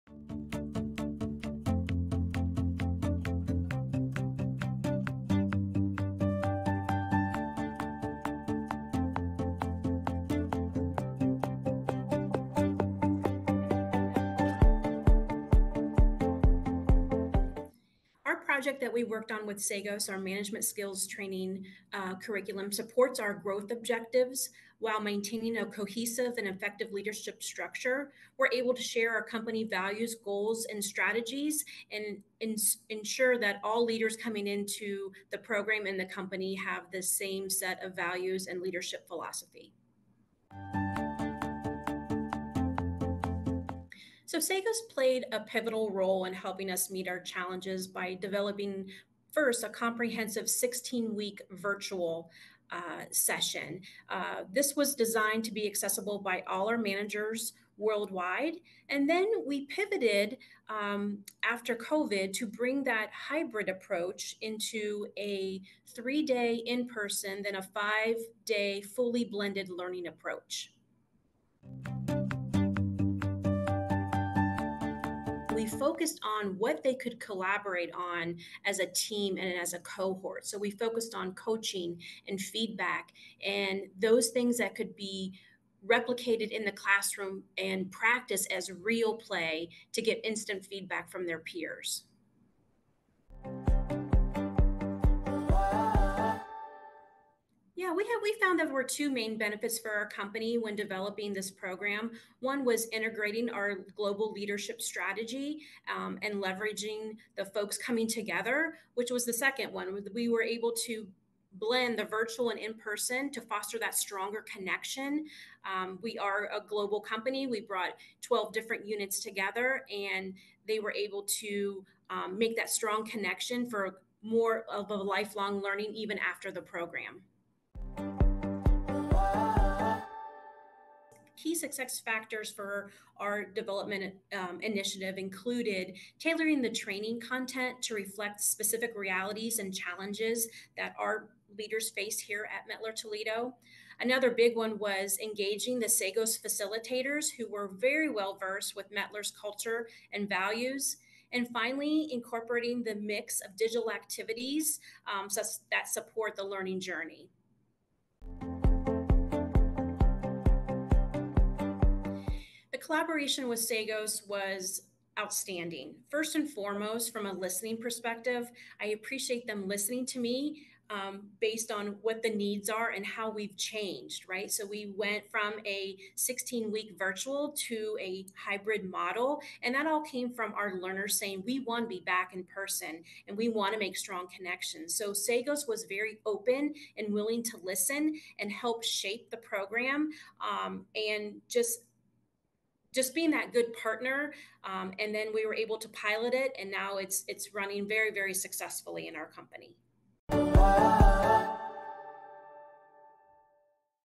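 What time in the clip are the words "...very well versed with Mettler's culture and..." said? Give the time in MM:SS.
02:27.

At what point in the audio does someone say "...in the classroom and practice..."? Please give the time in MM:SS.
01:26.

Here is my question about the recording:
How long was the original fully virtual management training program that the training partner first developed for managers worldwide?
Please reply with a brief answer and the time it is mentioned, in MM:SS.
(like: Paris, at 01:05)
16 weeks, at 00:50.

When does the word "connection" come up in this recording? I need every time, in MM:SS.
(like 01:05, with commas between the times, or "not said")
01:54, 02:03, 03:04.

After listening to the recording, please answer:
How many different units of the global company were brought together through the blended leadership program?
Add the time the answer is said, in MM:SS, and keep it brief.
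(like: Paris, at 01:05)
12, at 01:58.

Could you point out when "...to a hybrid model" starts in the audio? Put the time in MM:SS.
02:57.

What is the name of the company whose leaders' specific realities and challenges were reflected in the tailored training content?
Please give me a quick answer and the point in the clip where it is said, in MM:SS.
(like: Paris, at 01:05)
Mettler Toledo, at 02:22.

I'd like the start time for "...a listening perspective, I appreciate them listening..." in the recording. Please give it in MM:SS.
02:47.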